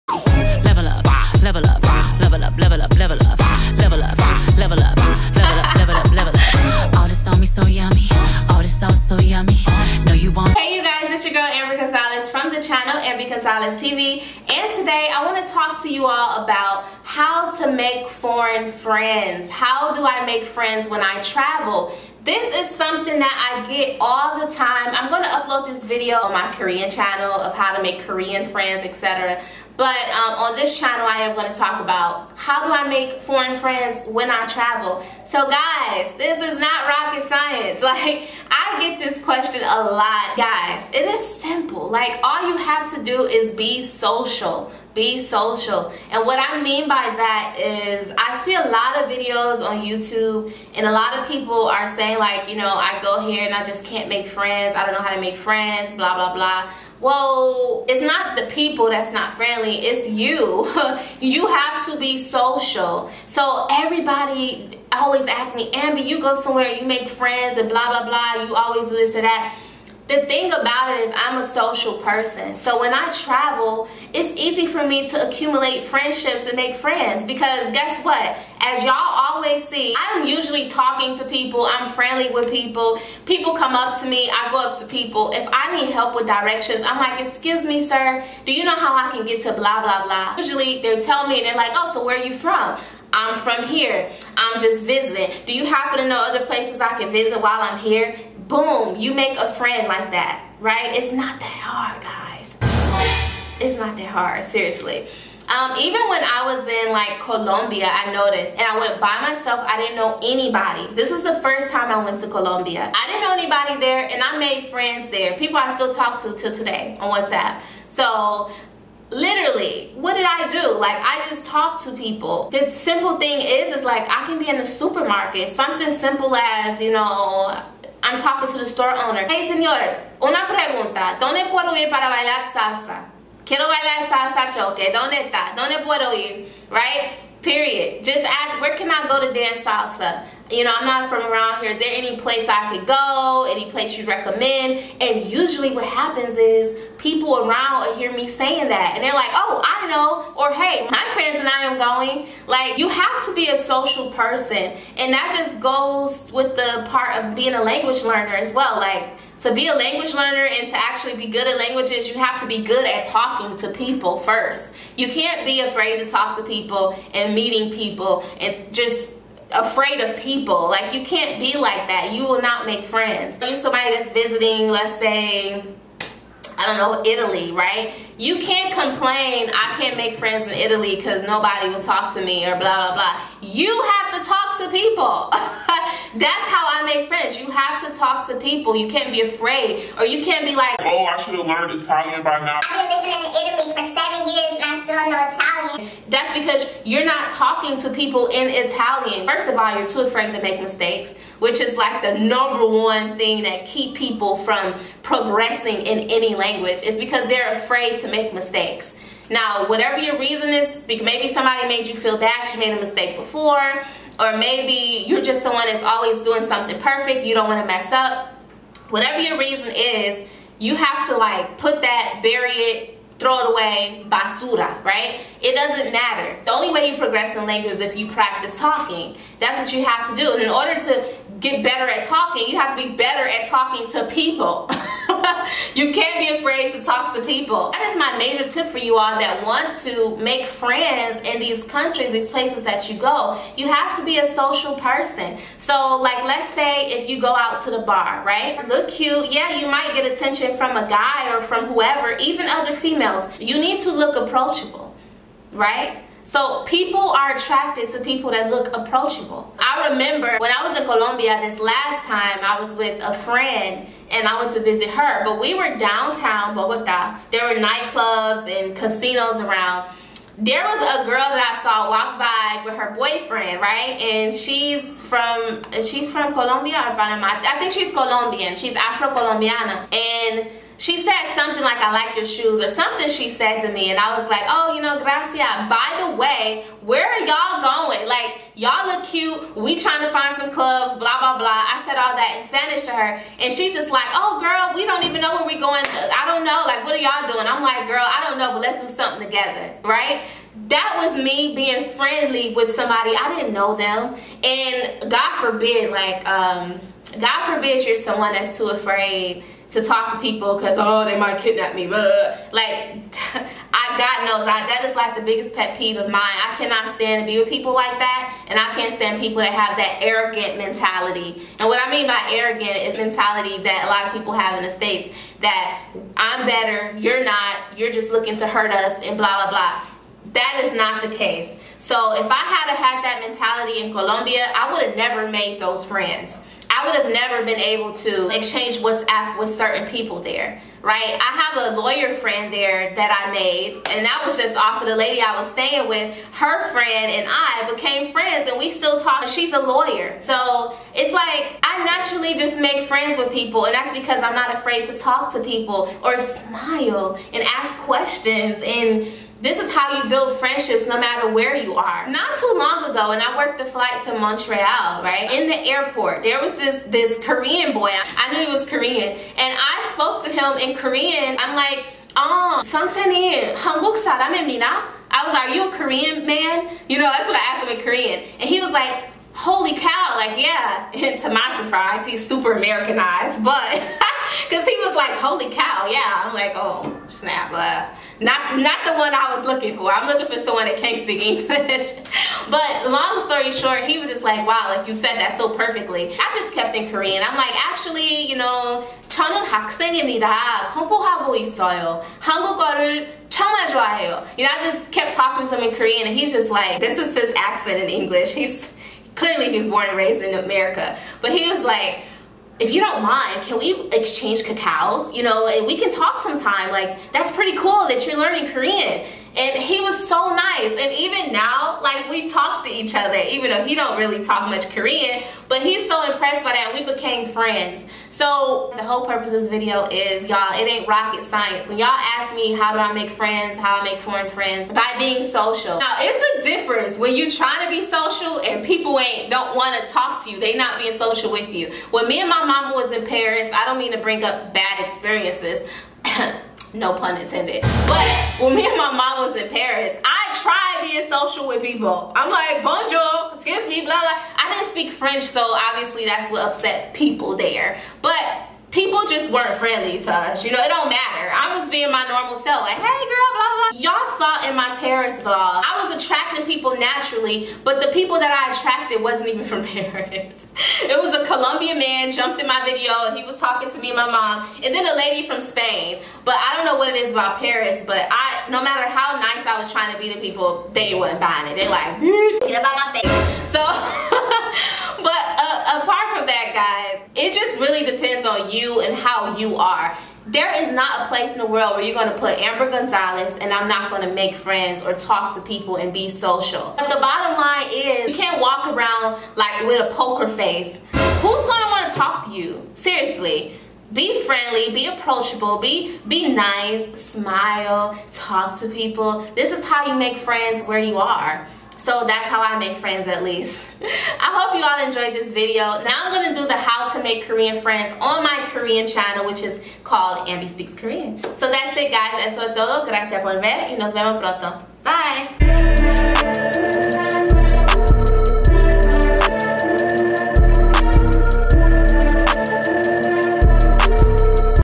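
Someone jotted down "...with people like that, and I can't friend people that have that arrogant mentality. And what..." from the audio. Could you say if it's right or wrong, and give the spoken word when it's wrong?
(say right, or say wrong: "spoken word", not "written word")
wrong: "stand", not "friend".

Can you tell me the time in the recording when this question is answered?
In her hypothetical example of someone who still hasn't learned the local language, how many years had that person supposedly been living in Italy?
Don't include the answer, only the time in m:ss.
3:13.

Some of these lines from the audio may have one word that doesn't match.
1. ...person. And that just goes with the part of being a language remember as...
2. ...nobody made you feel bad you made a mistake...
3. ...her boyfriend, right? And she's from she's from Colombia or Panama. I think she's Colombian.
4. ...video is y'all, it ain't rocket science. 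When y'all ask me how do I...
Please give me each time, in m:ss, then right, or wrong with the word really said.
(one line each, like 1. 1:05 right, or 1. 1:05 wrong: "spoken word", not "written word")
1. 2:34 wrong: "learner", not "remember"
2. 3:31 wrong: "somebody", not "nobody"
3. 4:32 right
4. 7:09 right.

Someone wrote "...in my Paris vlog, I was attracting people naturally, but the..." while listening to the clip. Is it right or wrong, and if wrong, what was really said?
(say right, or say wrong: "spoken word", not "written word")
right.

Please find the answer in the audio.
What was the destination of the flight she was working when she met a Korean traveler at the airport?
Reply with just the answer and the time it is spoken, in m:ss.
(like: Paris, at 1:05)
Montreal, at 6:04.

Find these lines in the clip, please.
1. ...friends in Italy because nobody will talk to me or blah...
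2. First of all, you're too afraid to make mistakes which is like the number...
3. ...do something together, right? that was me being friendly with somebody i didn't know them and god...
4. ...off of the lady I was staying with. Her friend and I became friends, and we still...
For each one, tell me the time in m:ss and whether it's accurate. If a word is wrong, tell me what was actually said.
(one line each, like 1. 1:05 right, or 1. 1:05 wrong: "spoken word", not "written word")
1. 3:00 right
2. 3:19 right
3. 4:58 right
4. 5:44 right.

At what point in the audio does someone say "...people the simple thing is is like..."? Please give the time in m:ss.
2:01.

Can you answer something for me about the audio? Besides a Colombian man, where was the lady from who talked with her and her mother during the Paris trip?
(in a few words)
Spain.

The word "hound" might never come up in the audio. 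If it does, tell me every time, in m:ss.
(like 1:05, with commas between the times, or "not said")
not said.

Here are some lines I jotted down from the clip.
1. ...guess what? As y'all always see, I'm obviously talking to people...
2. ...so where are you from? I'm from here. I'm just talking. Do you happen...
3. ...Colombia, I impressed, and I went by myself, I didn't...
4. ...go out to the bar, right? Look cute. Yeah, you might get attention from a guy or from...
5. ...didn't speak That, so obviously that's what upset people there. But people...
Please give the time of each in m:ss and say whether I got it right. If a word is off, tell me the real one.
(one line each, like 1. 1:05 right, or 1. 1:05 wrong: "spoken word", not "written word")
1. 1:17 wrong: "usually", not "obviously"
2. 1:31 wrong: "visiting", not "talking"
3. 1:47 wrong: "noticed", not "impressed"
4. 4:07 right
5. 7:34 wrong: "French", not "That".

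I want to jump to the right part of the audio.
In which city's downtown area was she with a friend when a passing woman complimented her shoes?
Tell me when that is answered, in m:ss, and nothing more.
4:25.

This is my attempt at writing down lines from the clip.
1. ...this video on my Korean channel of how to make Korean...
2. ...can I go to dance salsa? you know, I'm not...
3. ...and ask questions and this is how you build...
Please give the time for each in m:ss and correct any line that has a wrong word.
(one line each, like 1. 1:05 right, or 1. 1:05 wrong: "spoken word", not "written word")
1. 0:25 right
2. 2:18 right
3. 5:57 right.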